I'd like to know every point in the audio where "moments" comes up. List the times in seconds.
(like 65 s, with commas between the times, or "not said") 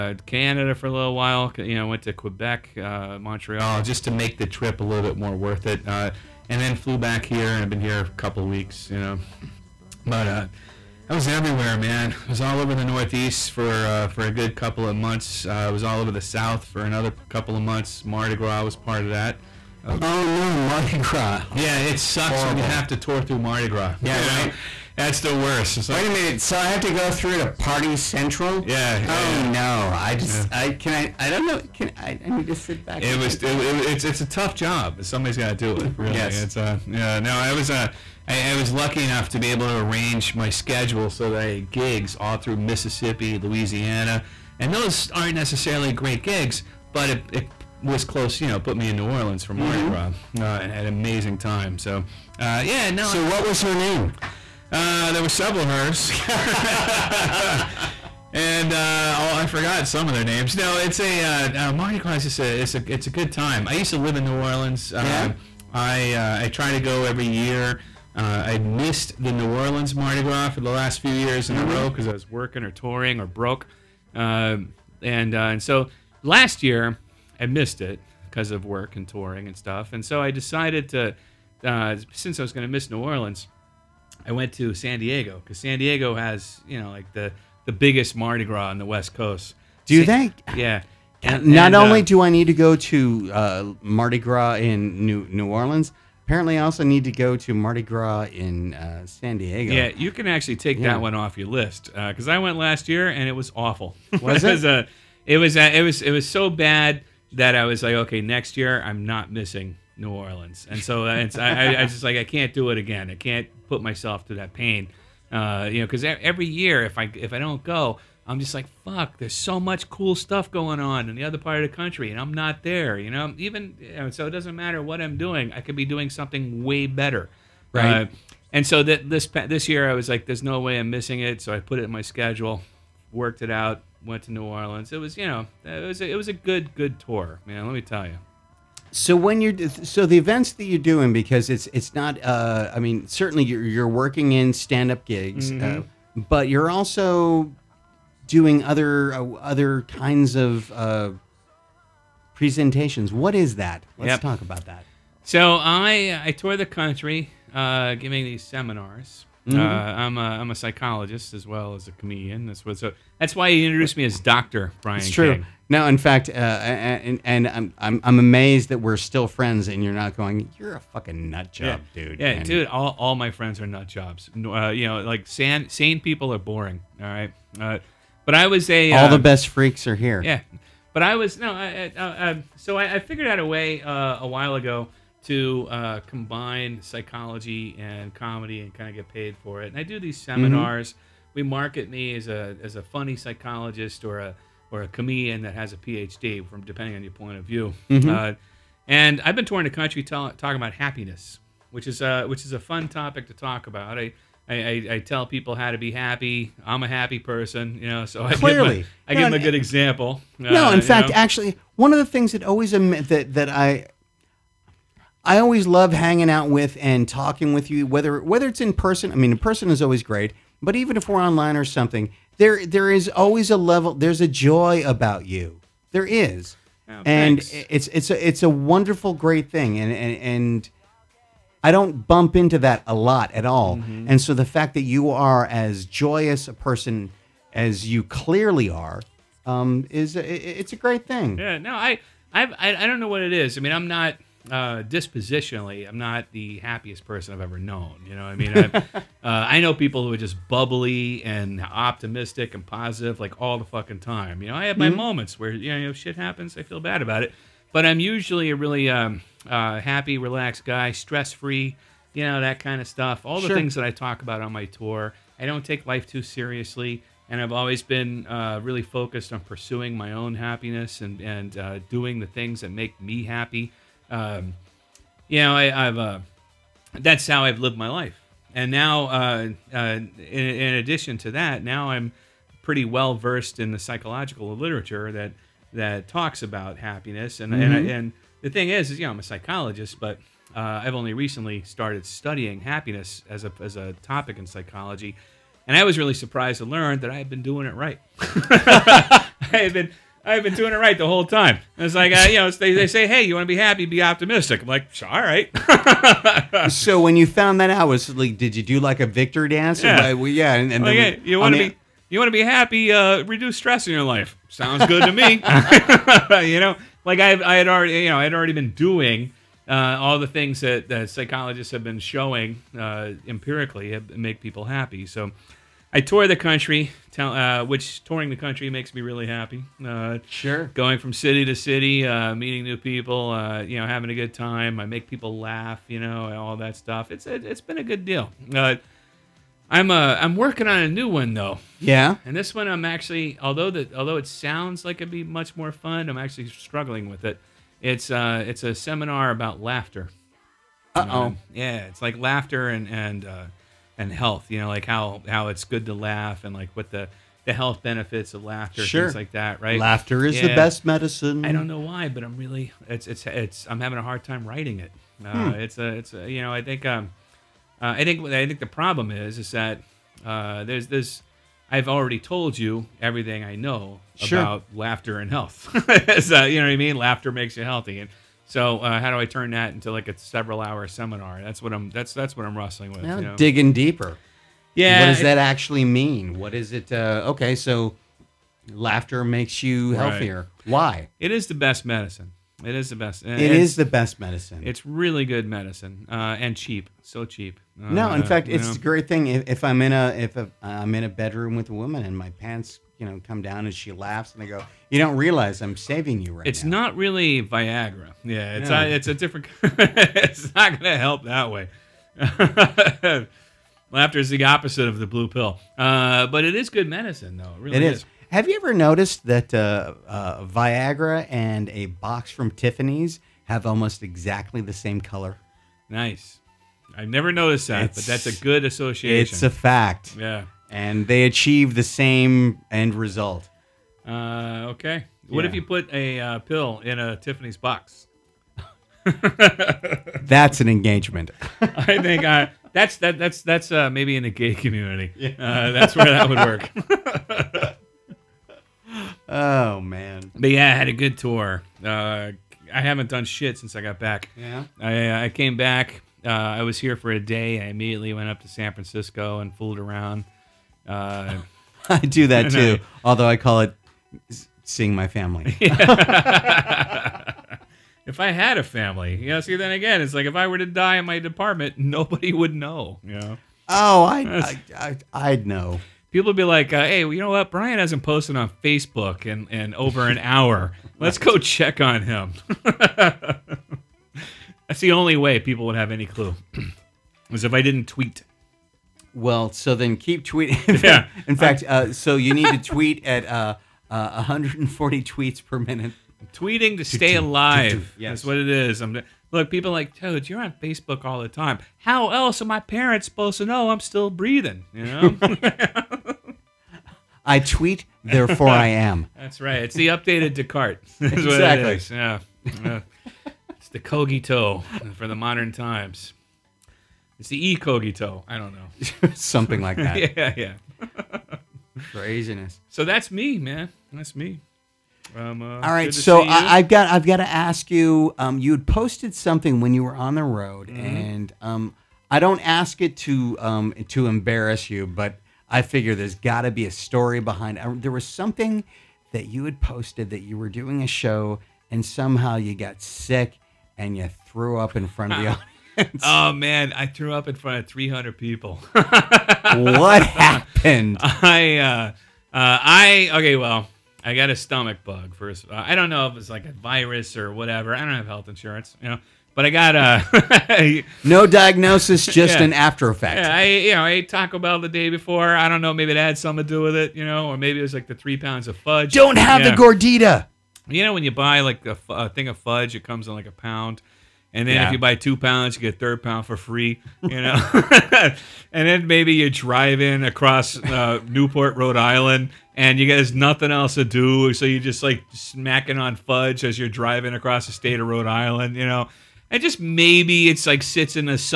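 254 s.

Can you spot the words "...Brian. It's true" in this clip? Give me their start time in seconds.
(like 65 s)
164 s.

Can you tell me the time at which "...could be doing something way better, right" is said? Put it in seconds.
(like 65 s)
125 s.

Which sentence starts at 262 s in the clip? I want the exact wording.
You know, that kind of stuff.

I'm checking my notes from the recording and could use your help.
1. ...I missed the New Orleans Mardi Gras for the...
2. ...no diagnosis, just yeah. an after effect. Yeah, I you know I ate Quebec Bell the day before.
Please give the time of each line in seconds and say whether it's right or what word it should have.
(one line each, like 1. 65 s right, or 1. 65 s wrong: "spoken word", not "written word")
1. 68 s right
2. 561 s wrong: "Taco", not "Quebec".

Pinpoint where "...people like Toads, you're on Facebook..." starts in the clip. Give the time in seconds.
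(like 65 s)
499 s.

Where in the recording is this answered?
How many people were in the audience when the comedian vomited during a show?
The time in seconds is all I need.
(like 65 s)
547 s.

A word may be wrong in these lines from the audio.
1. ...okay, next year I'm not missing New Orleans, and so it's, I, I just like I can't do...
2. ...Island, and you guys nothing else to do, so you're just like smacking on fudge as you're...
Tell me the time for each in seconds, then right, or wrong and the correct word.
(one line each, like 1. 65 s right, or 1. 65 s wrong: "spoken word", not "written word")
1. 107 s right
2. 581 s right.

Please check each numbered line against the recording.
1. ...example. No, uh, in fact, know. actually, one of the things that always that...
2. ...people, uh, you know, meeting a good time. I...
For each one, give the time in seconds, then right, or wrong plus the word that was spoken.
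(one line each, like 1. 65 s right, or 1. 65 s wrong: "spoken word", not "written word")
1. 209 s right
2. 332 s wrong: "having", not "meeting".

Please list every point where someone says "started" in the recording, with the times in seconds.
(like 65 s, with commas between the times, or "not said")
291 s.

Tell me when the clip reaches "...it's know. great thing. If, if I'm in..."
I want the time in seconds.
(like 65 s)
398 s.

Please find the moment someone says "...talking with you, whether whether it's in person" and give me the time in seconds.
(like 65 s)
217 s.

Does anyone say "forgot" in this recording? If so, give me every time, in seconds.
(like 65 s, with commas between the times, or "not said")
59 s.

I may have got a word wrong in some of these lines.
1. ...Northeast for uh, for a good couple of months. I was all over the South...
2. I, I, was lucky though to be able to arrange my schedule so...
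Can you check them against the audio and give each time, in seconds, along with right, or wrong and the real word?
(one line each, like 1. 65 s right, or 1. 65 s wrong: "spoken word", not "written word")
1. 12 s right
2. 38 s wrong: "enough", not "though".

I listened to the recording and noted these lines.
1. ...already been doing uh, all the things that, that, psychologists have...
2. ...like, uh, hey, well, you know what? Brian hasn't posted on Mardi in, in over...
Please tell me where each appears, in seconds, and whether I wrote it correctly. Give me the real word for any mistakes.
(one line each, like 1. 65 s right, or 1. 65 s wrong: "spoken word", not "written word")
1. 318 s right
2. 476 s wrong: "Facebook", not "Mardi".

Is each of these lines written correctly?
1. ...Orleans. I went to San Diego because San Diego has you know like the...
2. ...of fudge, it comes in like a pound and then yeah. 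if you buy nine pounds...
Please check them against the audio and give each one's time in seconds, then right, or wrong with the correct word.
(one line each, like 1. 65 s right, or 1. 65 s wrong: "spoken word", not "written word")
1. 83 s right
2. 572 s wrong: "two", not "nine".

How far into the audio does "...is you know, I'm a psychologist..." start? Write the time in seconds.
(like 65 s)
288 s.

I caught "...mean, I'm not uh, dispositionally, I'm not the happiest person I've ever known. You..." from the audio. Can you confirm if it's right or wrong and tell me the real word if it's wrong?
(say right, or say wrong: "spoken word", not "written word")
right.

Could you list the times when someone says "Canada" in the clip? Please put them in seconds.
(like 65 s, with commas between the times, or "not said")
0 s.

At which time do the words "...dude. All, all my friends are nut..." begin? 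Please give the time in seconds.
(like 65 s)
172 s.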